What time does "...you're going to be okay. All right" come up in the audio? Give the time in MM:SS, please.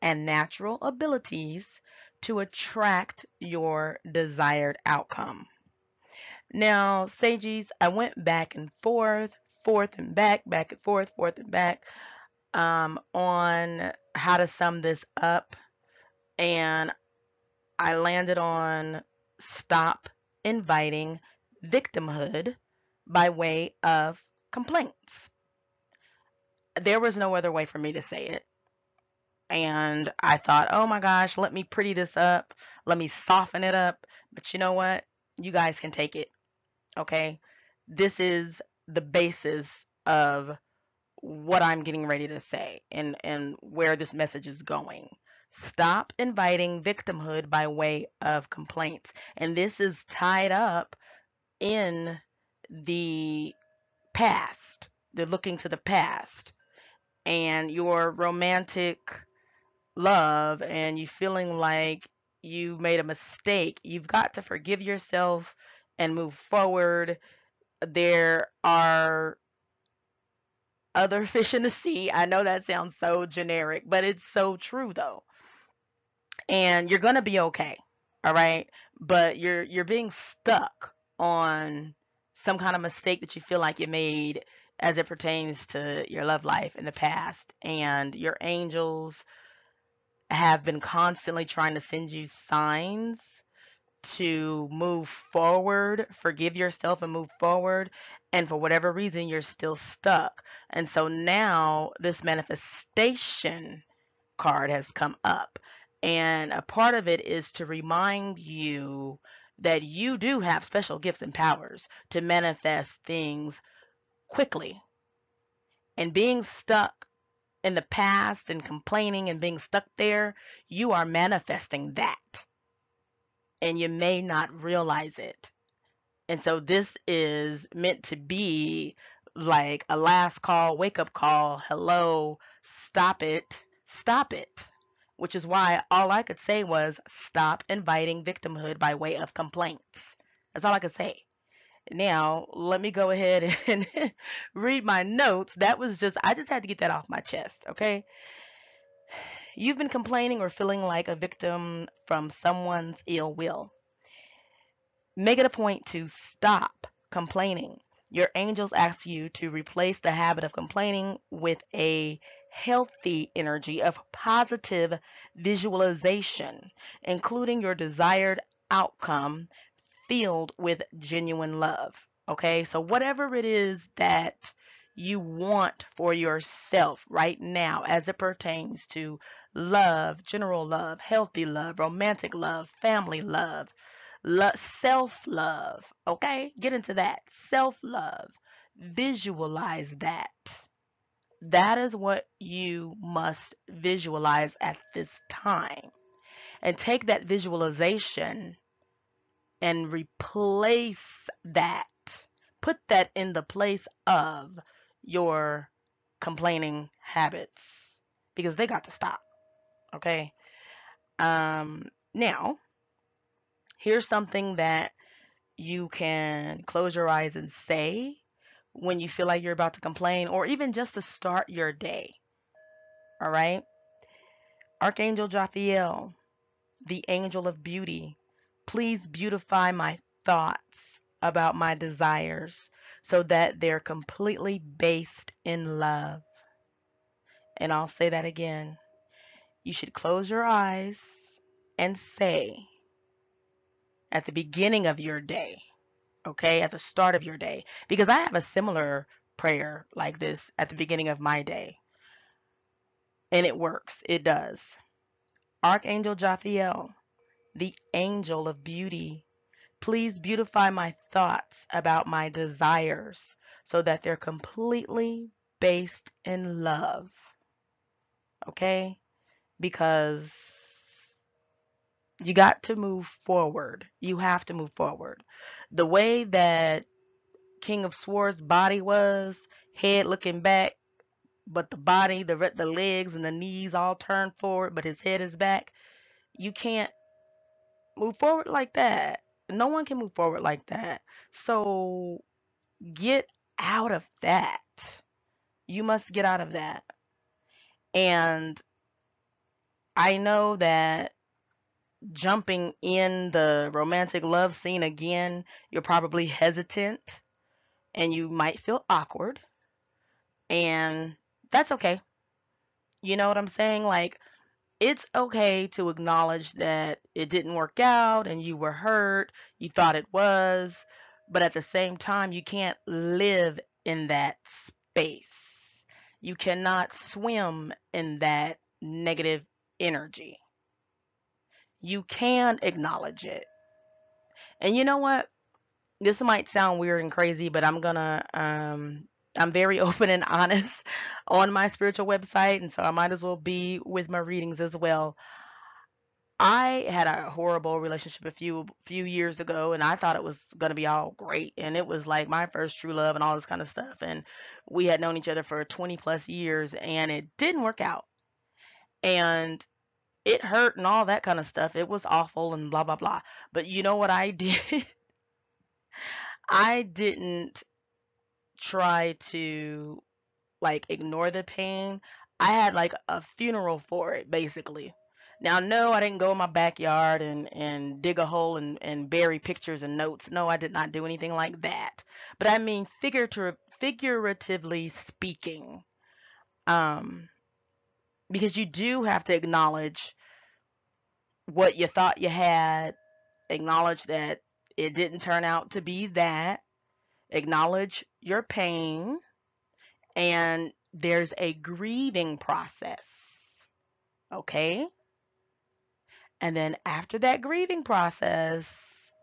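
01:16.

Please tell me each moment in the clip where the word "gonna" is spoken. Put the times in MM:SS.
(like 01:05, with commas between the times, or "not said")
05:50.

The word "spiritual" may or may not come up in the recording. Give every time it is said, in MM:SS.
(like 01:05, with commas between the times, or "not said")
05:41.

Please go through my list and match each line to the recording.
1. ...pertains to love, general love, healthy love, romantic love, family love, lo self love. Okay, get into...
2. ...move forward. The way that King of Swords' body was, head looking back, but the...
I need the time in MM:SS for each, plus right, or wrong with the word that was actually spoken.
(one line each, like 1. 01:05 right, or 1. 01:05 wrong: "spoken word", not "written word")
1. 02:58 right
2. 04:34 right.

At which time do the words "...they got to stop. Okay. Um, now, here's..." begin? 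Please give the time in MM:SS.
03:28.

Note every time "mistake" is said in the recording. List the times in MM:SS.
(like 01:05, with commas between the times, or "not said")
01:03, 01:22.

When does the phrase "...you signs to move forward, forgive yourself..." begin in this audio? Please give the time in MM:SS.
01:32.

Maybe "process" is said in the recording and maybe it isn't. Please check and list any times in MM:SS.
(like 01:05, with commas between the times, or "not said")
06:42, 06:47.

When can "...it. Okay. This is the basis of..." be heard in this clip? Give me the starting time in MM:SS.
00:36.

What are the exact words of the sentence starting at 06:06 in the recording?
I didn't try to like ignore the pain.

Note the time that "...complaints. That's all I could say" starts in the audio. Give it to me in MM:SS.
02:19.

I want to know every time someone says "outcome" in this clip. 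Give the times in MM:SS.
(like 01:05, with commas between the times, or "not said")
00:04, 02:48.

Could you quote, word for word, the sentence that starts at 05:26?
You cannot swim in that negative energy.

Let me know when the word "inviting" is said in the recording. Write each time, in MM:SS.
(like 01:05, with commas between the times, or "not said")
00:20, 00:46, 02:17.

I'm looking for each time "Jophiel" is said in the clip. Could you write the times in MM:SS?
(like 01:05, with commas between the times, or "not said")
03:45, 04:16.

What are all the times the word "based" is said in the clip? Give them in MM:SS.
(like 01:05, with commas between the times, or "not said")
03:54, 04:25.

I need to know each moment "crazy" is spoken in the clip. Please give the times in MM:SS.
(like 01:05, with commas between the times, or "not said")
05:37.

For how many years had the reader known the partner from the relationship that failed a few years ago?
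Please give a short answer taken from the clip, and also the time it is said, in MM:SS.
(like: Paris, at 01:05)
20 plus years, at 05:55.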